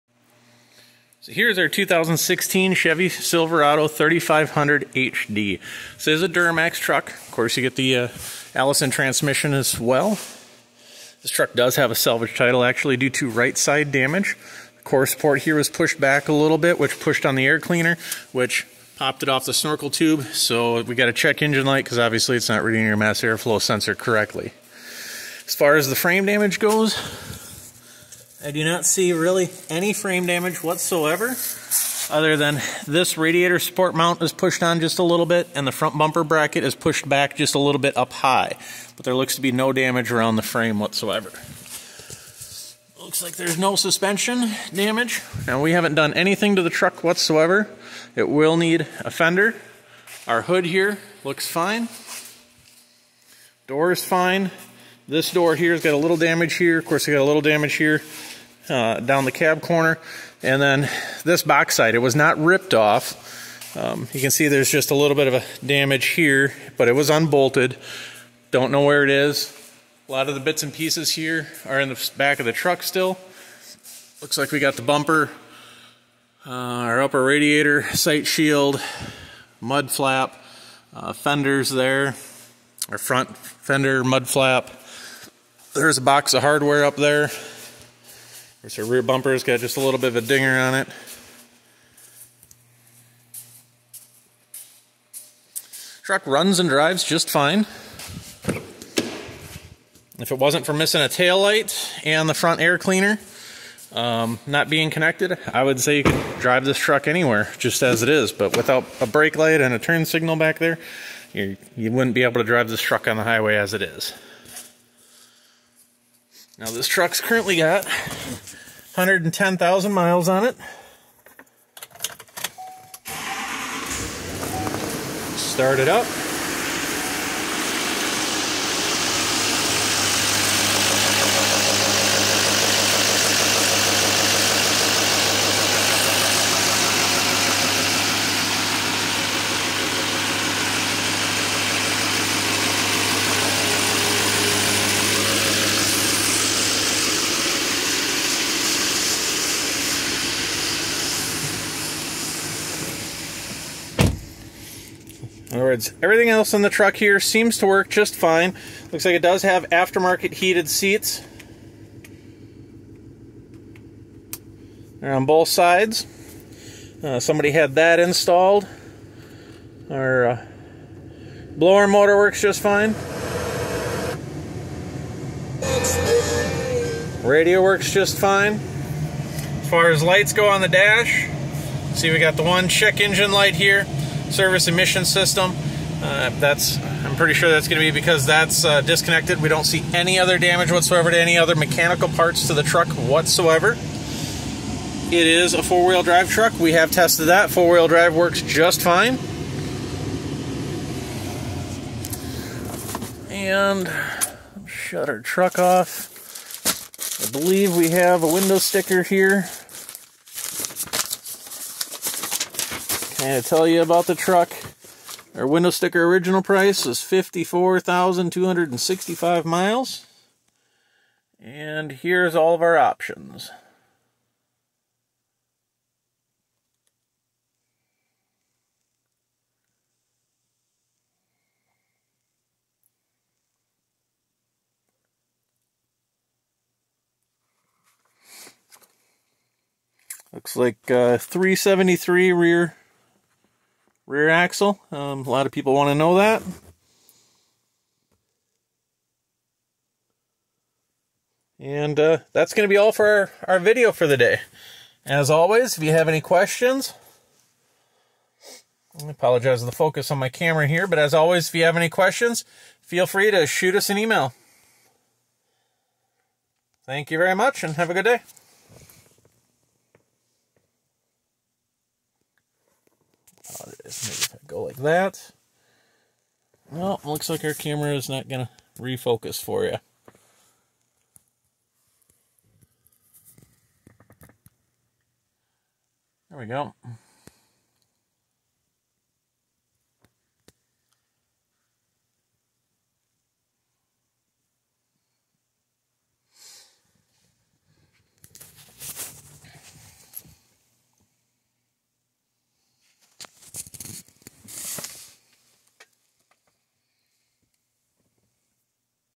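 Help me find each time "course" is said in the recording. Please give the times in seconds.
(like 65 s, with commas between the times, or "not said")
7 s, 56 s.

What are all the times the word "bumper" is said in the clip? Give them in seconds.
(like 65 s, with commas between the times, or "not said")
35 s, 74 s, 89 s.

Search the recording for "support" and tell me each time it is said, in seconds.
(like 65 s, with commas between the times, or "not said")
15 s, 33 s.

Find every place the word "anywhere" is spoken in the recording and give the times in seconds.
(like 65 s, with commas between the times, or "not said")
107 s.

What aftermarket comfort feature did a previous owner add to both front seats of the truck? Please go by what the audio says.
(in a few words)
Heated seats.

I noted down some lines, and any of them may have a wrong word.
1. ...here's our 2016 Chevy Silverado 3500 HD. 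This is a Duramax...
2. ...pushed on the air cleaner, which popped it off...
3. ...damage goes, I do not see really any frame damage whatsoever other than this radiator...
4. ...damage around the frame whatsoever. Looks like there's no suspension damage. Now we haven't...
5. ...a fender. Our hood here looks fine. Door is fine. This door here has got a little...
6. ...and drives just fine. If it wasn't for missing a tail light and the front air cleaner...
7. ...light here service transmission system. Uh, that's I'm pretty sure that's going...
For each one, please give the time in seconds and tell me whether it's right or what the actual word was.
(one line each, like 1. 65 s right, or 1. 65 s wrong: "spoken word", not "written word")
1. 1 s right
2. 16 s right
3. 26 s right
4. 39 s right
5. 49 s right
6. 96 s right
7. 183 s wrong: "emission", not "transmission".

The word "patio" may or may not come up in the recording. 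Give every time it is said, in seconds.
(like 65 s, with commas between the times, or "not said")
not said.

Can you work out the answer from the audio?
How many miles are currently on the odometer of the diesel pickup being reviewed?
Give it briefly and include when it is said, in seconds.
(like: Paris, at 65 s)
110,000, at 117 s.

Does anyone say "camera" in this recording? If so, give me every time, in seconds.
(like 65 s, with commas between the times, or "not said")
260 s, 277 s.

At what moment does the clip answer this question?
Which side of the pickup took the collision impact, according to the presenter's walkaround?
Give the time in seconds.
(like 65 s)
13 s.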